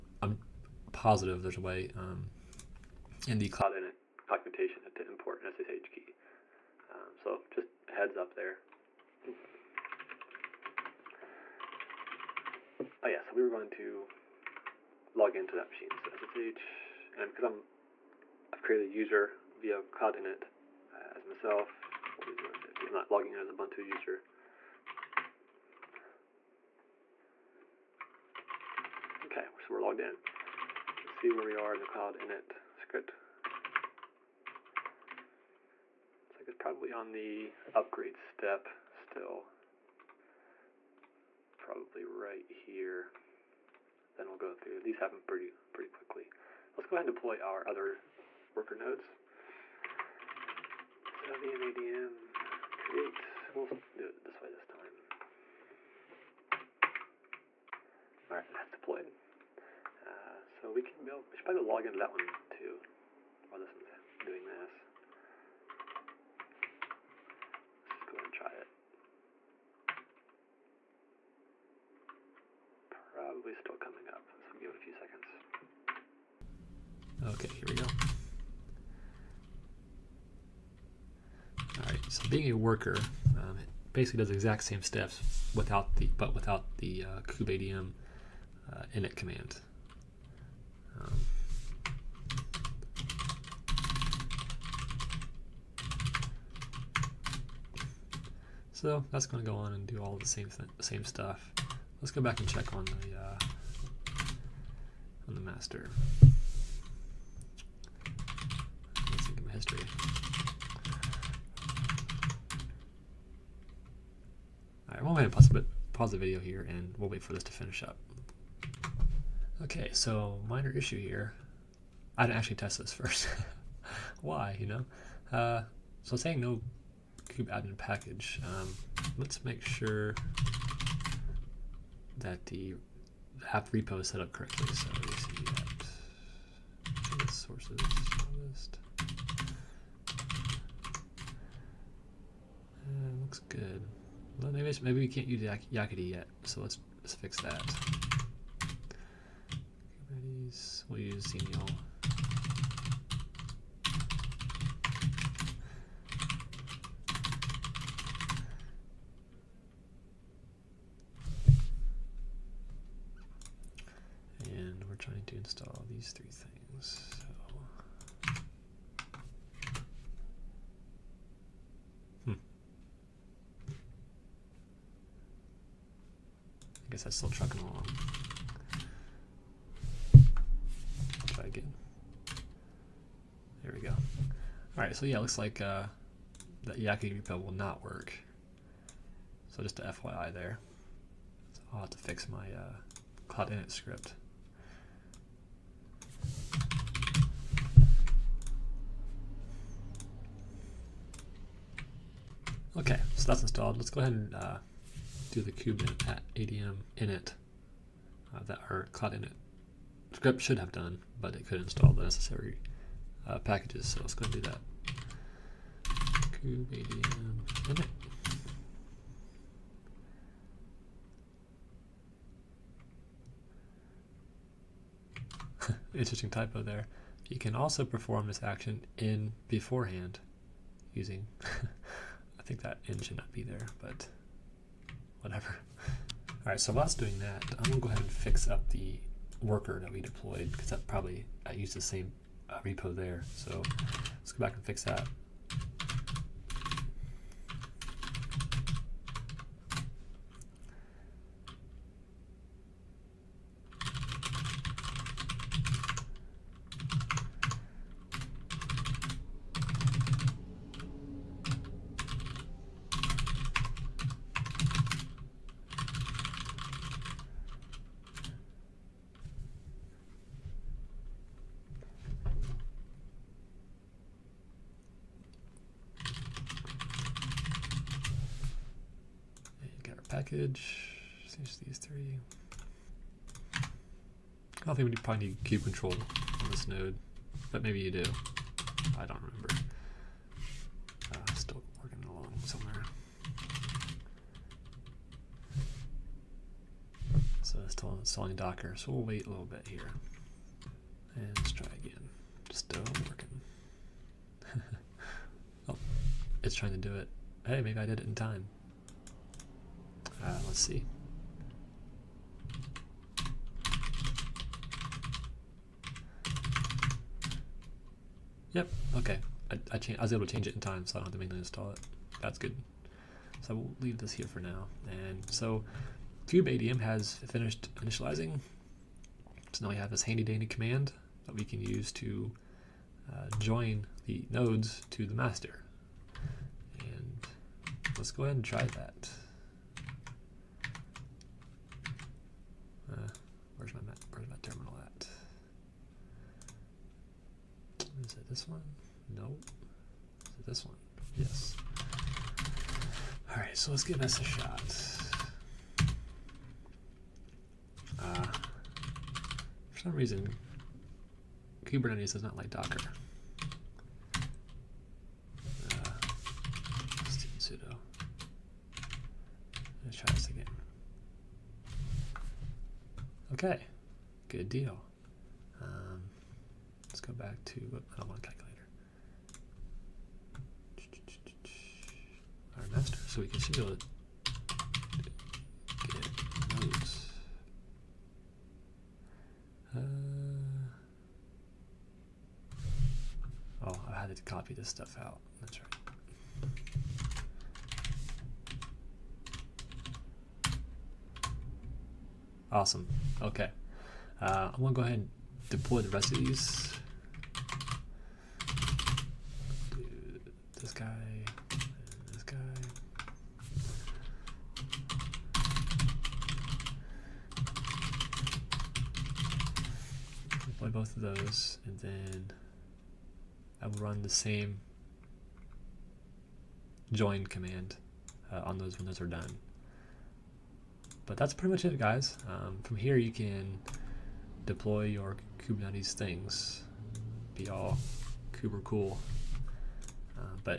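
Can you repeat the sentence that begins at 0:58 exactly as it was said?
All right, that's deployed so we can build, we should probably log into that one too while this one's doing this.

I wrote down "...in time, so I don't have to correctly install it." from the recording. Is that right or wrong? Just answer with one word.
wrong.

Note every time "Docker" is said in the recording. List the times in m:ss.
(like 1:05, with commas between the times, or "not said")
4:58, 6:02.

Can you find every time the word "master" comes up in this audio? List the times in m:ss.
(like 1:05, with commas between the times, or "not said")
1:45, 5:35.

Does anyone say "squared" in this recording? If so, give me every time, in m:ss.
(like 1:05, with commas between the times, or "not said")
not said.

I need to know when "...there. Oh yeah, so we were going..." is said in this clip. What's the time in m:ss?
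0:08.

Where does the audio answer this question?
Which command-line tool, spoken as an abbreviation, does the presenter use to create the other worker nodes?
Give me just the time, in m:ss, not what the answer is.
0:51.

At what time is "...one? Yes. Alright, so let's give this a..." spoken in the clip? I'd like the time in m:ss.
5:50.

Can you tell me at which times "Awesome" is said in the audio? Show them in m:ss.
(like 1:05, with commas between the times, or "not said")
6:42.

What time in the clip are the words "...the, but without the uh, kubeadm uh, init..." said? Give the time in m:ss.
1:25.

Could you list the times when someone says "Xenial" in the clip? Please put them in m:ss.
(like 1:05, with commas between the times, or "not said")
2:31.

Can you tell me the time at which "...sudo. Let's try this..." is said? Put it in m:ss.
6:07.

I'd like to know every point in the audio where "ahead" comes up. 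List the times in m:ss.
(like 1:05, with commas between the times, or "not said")
0:46, 1:08, 3:23, 3:57, 5:38, 6:44.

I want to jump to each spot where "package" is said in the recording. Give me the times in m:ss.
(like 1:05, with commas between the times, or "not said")
2:07, 3:33, 4:40.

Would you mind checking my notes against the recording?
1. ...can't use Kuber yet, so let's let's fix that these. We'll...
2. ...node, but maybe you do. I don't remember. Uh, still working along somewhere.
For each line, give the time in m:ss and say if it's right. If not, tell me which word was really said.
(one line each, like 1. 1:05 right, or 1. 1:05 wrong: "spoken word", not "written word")
1. 2:25 wrong: "Yakkety", not "Kuber"
2. 4:46 right.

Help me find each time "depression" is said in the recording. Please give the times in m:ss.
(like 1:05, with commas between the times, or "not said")
not said.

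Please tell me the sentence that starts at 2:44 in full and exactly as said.
And we're trying to install these three things.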